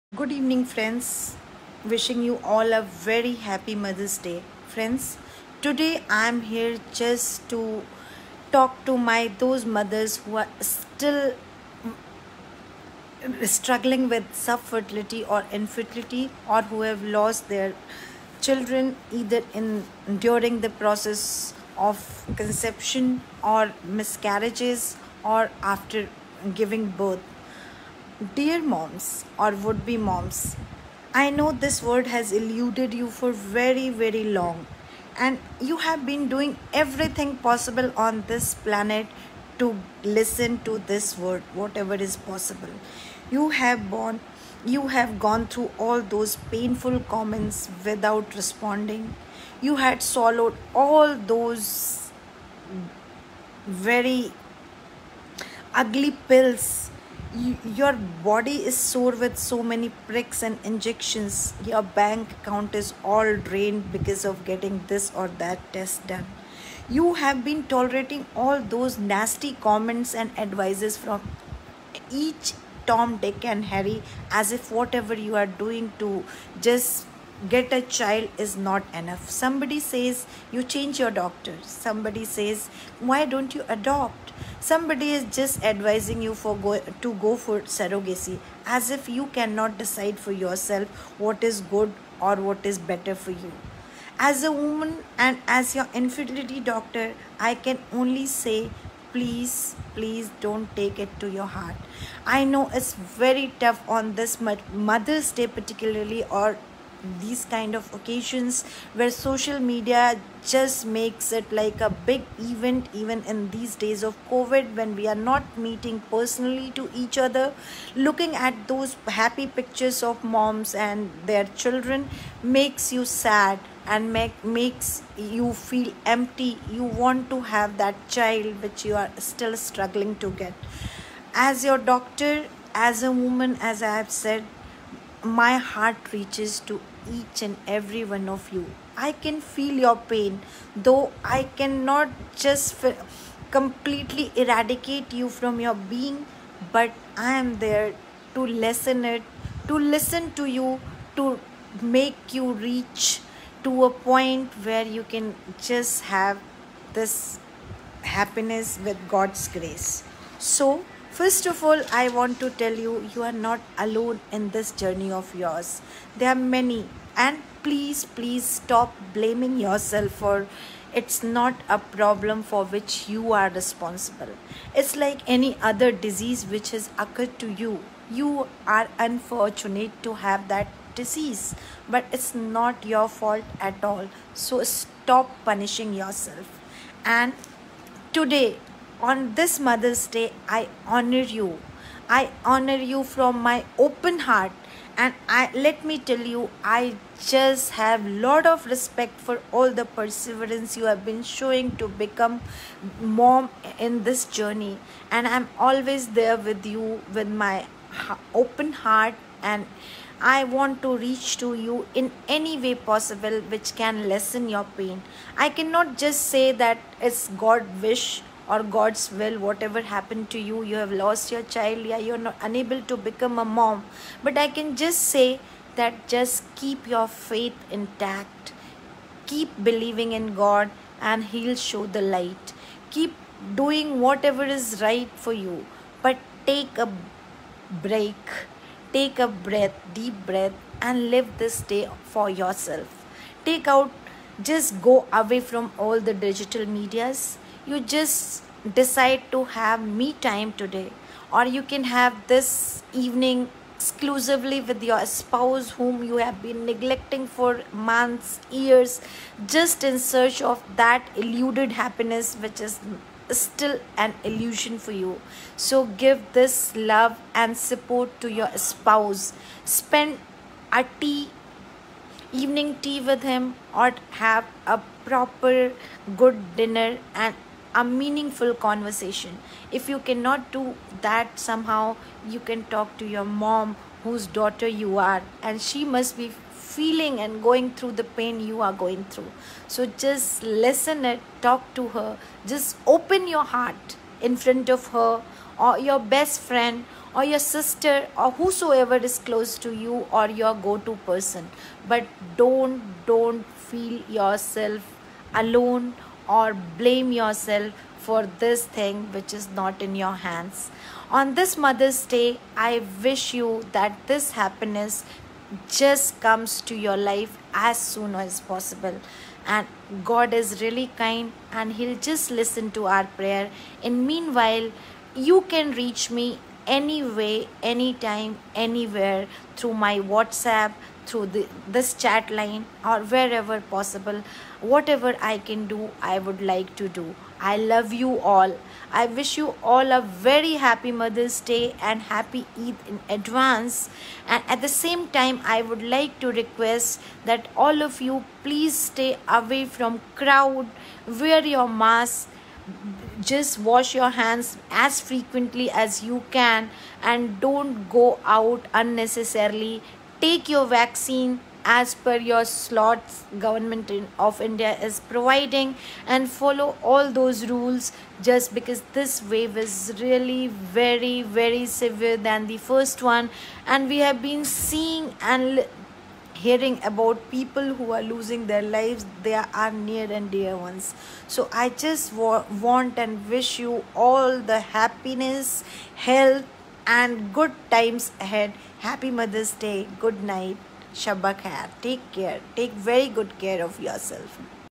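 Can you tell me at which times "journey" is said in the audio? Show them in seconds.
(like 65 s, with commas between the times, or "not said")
164 s, 204 s.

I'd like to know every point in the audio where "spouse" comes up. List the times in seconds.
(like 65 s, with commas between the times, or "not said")
255 s, 268 s.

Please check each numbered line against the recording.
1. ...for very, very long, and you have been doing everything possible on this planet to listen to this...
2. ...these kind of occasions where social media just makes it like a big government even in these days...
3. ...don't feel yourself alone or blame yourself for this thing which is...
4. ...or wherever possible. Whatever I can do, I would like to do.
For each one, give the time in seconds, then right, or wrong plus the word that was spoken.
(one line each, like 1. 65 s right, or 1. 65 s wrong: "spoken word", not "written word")
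1. 33 s right
2. 107 s wrong: "event", not "government"
3. 303 s right
4. 332 s right.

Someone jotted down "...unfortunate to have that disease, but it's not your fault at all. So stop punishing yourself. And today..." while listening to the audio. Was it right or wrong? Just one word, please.
right.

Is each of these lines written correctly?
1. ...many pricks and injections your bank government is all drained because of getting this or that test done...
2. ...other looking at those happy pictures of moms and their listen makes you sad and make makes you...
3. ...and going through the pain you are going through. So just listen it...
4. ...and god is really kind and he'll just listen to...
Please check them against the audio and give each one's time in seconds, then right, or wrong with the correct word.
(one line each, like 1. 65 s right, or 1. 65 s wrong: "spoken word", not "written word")
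1. 59 s wrong: "account", not "government"
2. 117 s wrong: "children", not "listen"
3. 287 s right
4. 319 s right.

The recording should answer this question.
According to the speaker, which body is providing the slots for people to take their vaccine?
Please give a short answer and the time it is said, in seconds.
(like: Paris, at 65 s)
Government of India, at 363 s.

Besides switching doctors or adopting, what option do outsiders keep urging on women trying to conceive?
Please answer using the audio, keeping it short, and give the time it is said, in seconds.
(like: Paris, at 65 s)
surrogacy, at 87 s.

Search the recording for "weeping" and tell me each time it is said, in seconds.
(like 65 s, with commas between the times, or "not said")
not said.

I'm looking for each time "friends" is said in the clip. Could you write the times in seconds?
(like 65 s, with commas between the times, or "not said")
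0 s, 4 s, 296 s.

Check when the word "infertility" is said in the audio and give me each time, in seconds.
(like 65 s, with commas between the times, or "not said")
15 s, 95 s.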